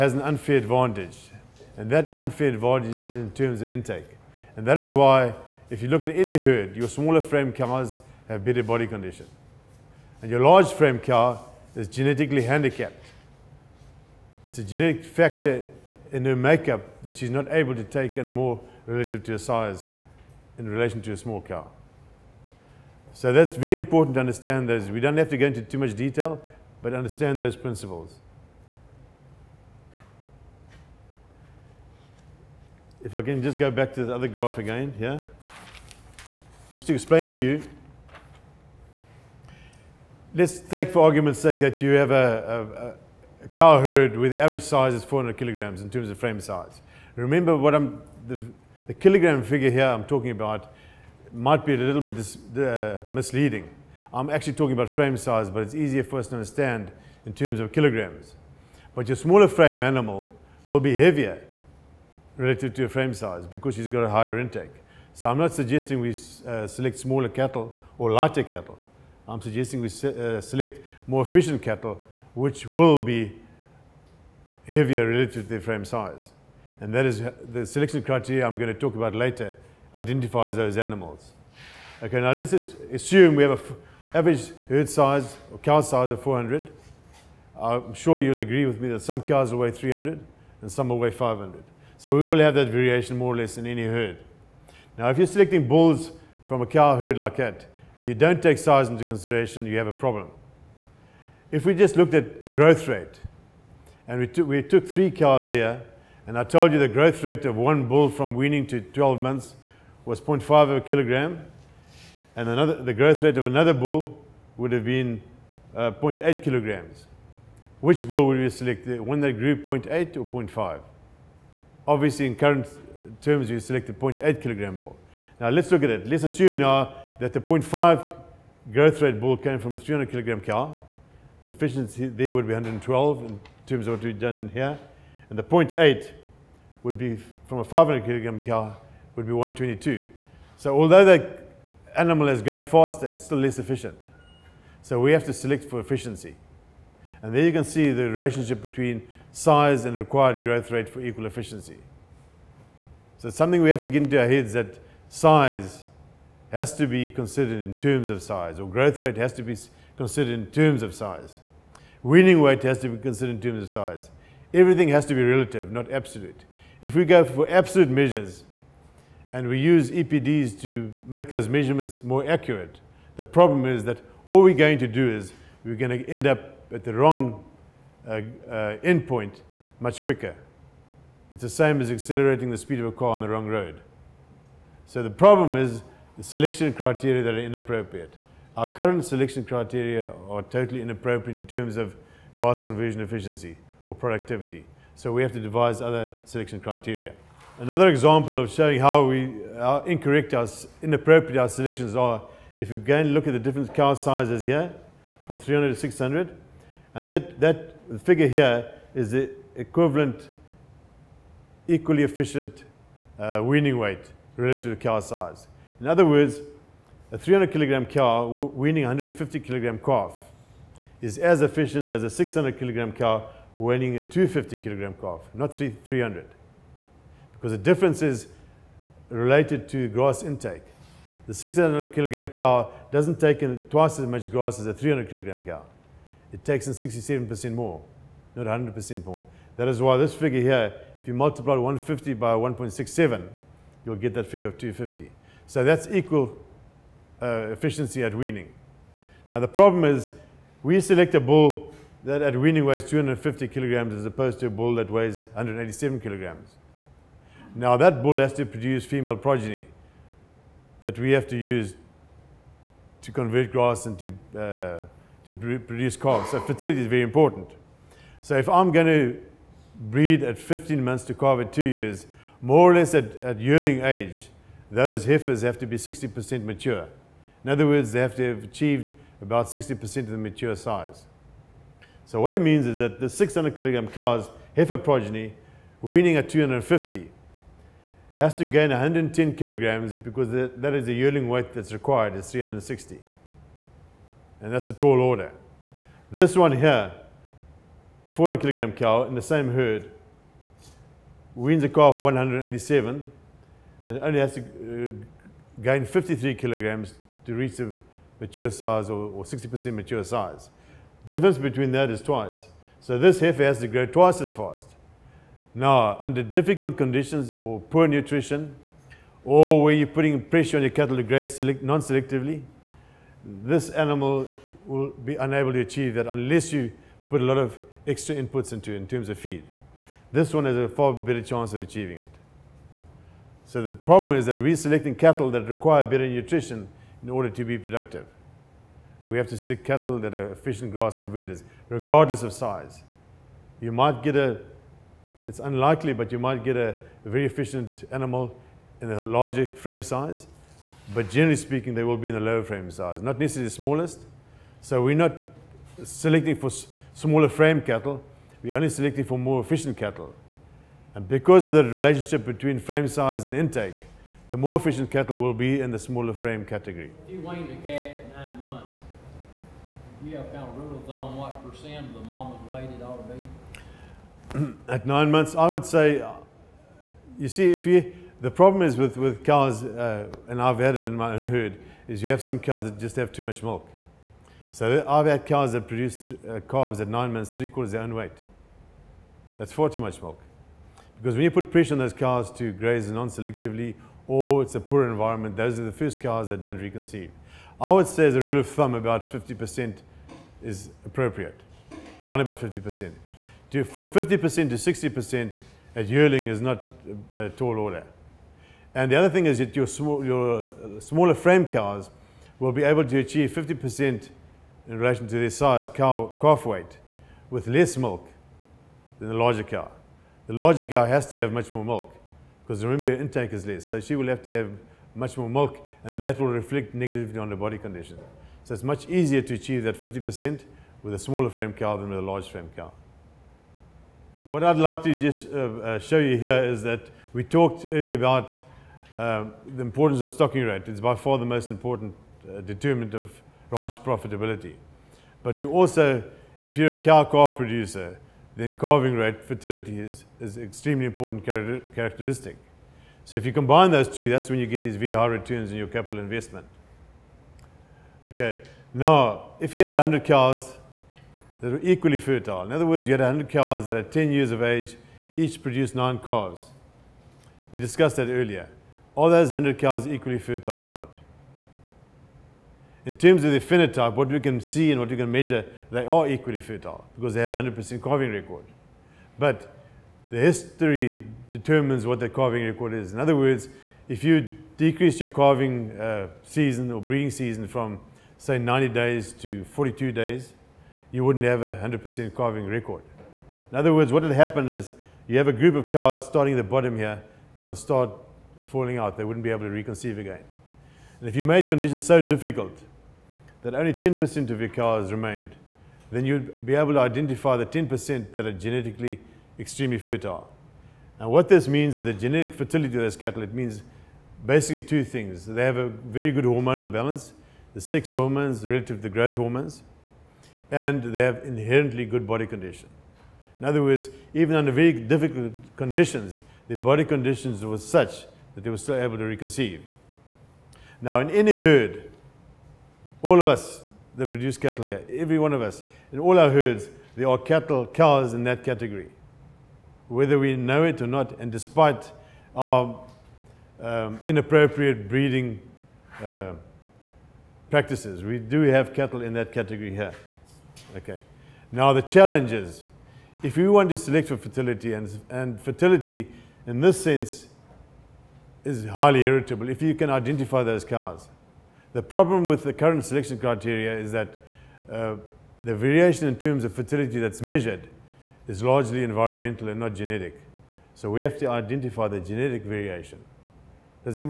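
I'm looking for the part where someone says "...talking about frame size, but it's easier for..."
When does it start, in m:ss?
0:54.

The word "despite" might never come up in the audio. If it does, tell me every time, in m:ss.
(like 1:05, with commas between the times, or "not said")
9:01.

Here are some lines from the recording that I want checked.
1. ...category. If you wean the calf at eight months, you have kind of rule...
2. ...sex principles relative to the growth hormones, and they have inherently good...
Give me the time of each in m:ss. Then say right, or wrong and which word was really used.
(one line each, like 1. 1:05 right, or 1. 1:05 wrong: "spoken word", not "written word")
1. 6:06 wrong: "nine", not "eight"
2. 8:37 wrong: "hormones", not "principles".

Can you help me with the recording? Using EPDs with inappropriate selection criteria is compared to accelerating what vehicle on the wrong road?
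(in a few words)
a car.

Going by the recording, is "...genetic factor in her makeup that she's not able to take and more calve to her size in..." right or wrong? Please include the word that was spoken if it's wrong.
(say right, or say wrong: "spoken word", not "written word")
wrong: "relative", not "calve".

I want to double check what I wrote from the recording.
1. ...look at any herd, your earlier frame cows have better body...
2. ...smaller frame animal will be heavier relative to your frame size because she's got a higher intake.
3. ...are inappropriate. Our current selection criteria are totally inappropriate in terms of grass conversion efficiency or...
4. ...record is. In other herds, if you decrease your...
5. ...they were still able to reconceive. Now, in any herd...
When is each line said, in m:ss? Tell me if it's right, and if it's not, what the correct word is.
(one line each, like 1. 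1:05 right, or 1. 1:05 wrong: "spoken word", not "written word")
1. 0:05 wrong: "smaller", not "earlier"
2. 0:59 right
3. 3:07 right
4. 8:02 wrong: "words", not "herds"
5. 8:48 right.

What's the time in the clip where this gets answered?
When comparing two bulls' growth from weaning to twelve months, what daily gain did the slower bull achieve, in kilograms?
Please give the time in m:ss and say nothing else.
1:50.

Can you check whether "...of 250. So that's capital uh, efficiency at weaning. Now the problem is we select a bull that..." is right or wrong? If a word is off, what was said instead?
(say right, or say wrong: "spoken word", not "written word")
wrong: "equal", not "capital".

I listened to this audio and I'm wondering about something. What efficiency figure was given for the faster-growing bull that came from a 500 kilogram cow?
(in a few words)
122.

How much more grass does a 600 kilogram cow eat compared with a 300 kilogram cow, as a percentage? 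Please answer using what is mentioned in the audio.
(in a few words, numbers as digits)
67%.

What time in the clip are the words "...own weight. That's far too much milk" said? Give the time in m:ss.
6:27.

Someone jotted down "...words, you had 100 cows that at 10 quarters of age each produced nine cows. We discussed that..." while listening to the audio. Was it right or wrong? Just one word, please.
wrong.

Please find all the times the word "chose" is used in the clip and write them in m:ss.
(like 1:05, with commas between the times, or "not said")
not said.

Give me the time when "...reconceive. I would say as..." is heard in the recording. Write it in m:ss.
6:36.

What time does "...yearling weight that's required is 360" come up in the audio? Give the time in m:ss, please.
4:50.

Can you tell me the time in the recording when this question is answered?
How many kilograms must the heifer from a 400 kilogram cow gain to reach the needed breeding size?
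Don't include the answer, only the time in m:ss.
5:05.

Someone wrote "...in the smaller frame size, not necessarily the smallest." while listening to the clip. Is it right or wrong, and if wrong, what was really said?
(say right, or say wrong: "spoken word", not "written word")
wrong: "lower", not "smaller".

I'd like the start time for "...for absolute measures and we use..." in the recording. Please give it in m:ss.
2:47.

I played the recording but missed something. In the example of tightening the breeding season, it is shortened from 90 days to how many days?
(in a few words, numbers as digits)
42.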